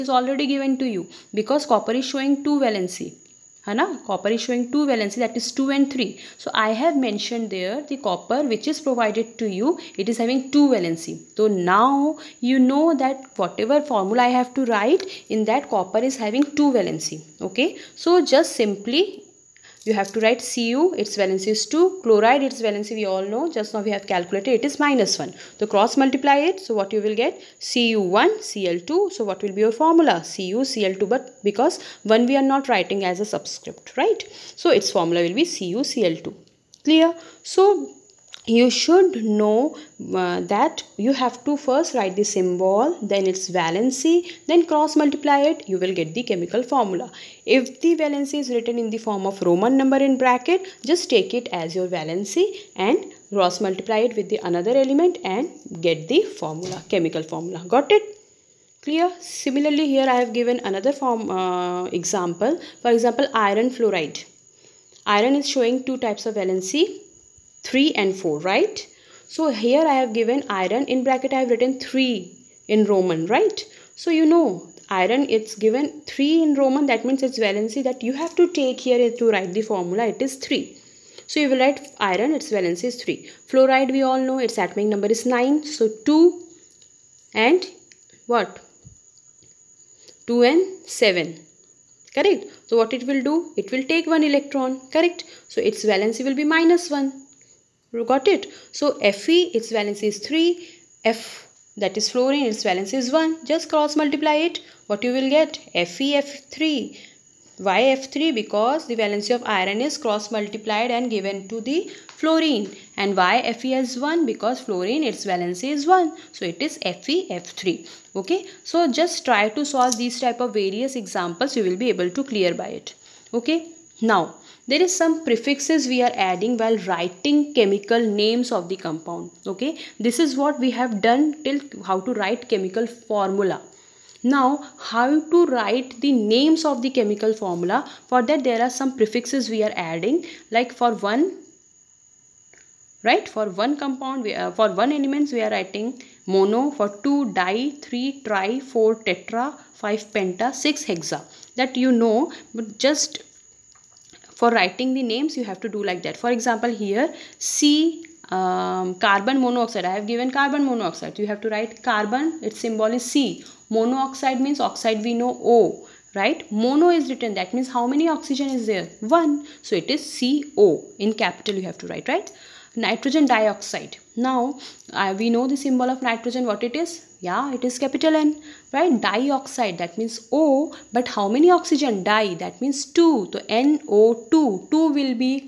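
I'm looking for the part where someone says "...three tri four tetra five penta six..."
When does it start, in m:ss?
2:27.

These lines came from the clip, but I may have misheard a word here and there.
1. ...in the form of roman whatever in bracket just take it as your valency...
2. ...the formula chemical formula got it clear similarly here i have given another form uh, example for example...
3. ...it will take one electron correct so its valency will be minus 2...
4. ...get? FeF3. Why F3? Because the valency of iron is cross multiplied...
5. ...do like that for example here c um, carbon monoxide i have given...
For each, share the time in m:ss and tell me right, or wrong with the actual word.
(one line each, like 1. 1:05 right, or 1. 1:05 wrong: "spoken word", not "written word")
1. 0:48 wrong: "number", not "whatever"
2. 0:56 right
3. 1:33 wrong: "1", not "2"
4. 1:45 right
5. 2:35 right.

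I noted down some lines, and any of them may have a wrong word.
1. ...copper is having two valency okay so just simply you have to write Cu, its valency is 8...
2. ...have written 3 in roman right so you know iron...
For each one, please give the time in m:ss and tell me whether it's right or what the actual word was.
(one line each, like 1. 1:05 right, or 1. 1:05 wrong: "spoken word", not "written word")
1. 0:15 wrong: "2", not "8"
2. 1:11 right.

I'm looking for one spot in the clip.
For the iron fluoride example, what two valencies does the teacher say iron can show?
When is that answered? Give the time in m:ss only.
1:07.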